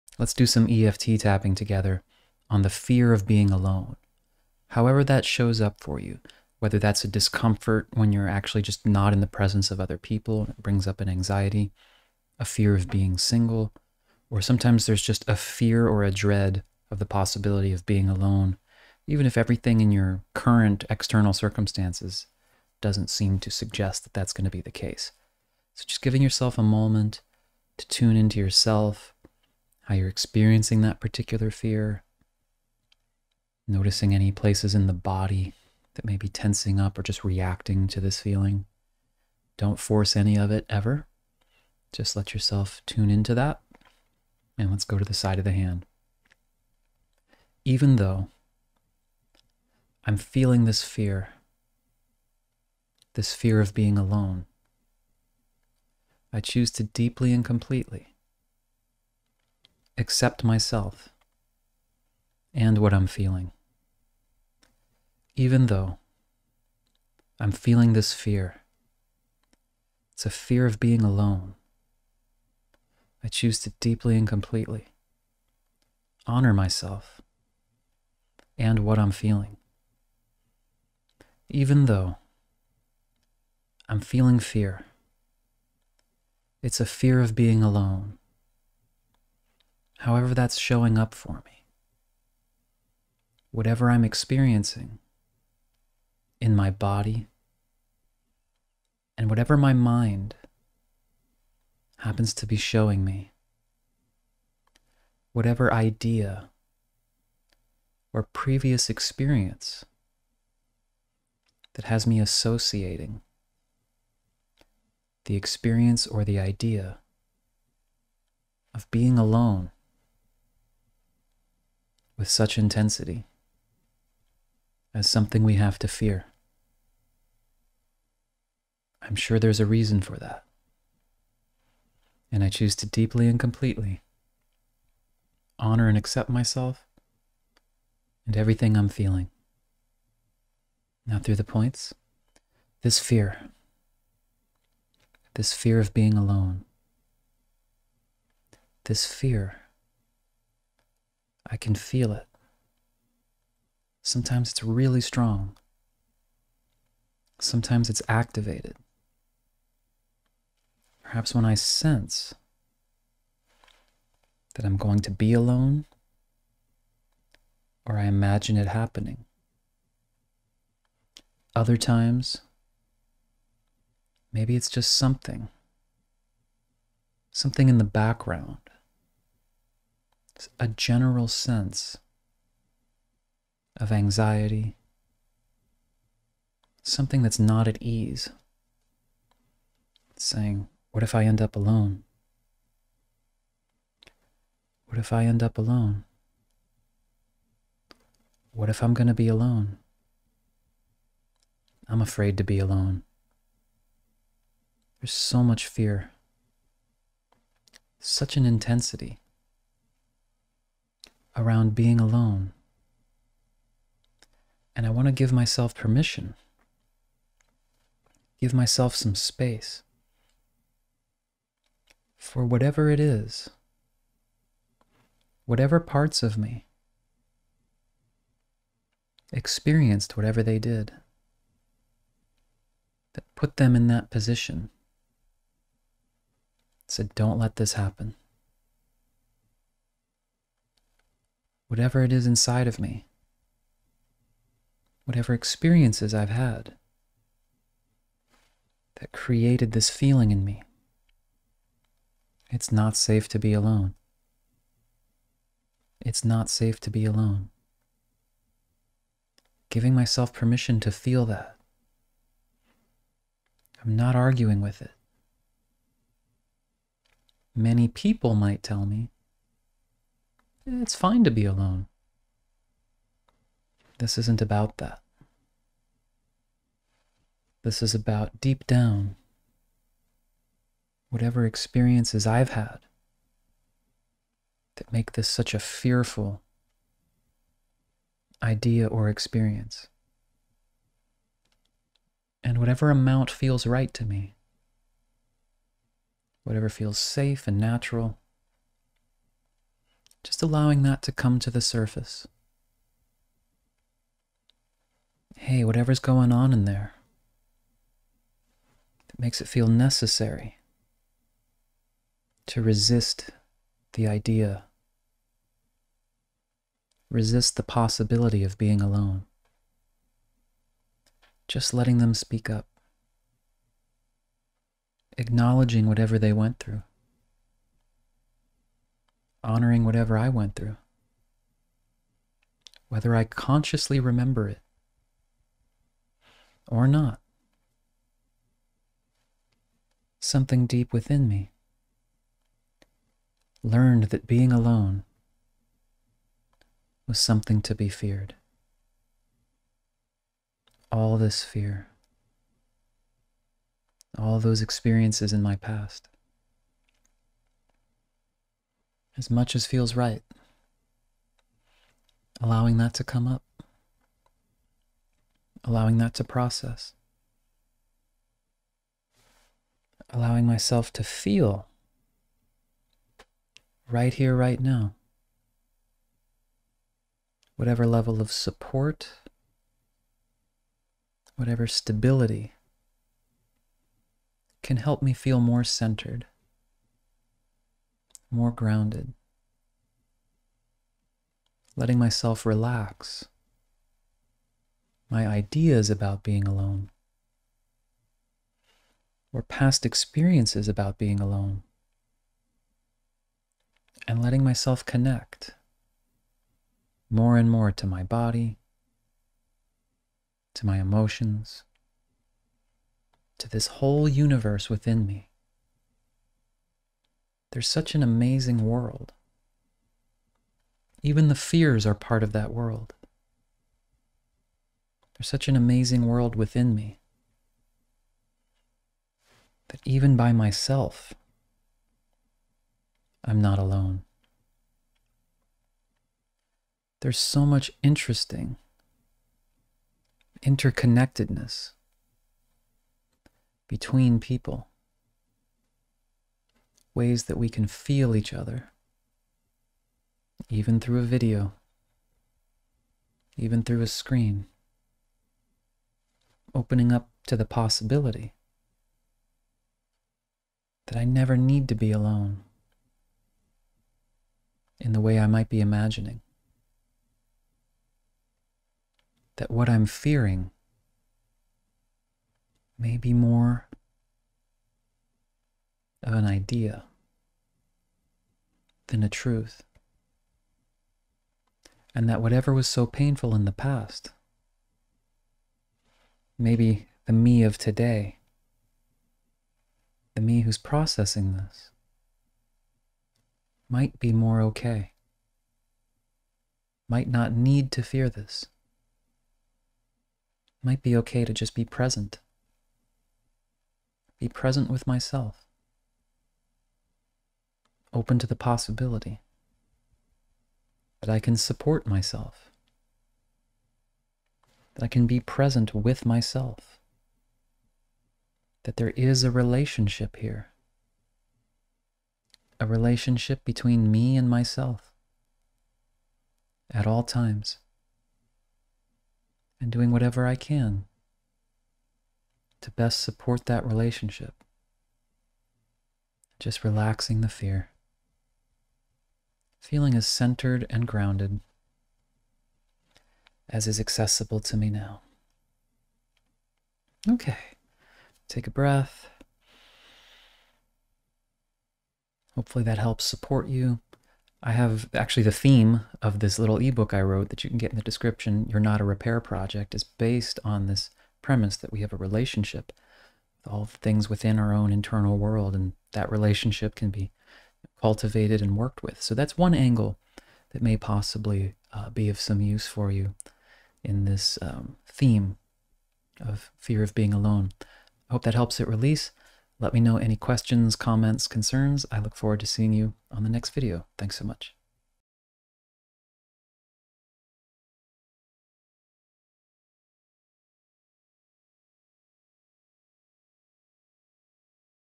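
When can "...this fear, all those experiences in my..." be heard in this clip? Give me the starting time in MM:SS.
05:51.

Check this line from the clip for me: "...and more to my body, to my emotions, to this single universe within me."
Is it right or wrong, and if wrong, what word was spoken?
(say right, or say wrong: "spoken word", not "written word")
wrong: "whole", not "single".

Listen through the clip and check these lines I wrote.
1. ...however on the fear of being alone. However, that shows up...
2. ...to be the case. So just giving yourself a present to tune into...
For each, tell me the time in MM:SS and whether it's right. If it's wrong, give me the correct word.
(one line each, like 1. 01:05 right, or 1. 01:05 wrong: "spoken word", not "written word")
1. 00:01 wrong: "together", not "however"
2. 00:24 wrong: "moment", not "present".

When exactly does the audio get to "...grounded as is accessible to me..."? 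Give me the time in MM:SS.
09:00.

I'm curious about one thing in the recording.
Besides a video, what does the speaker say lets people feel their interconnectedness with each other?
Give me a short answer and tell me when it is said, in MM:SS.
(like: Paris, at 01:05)
A screen, at 07:33.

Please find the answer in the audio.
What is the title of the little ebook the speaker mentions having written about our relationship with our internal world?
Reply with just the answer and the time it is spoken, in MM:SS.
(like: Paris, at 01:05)
You're Not a Repair Project, at 09:18.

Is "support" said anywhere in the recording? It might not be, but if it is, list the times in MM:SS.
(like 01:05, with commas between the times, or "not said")
06:18, 08:31, 08:53, 09:13.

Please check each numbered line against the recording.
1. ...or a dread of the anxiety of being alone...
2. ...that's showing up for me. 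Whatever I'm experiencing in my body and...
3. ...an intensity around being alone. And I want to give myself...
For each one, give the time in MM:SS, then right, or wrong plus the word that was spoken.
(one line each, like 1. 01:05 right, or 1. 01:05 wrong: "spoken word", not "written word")
1. 00:15 wrong: "possibility", not "anxiety"
2. 01:30 right
3. 03:28 right.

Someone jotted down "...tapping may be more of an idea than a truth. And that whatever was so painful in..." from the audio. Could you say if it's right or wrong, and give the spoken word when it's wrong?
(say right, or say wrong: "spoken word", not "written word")
wrong: "fearing", not "tapping".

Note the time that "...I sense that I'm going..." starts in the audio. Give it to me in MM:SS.
02:41.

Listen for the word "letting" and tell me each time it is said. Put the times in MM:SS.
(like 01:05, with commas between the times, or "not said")
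05:21, 06:31, 06:44.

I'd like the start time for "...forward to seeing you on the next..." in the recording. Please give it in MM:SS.
09:42.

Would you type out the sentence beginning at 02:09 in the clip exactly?
I'm sure there's a reason for that.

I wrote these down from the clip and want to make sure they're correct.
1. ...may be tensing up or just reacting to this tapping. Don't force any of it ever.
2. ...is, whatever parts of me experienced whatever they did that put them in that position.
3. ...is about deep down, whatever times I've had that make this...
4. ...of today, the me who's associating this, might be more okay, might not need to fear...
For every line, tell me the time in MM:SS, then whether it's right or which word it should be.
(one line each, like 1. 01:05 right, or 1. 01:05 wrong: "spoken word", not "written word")
1. 00:36 wrong: "feeling", not "tapping"
2. 03:42 right
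3. 04:37 wrong: "experiences", not "times"
4. 08:07 wrong: "processing", not "associating".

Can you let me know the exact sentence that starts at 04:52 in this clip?
And whatever amount feels right to me, whatever feels safe and natural, allowing that to come to the surface.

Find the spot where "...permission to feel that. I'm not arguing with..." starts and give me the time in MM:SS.
04:20.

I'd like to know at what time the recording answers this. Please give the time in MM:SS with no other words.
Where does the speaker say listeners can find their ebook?
09:17.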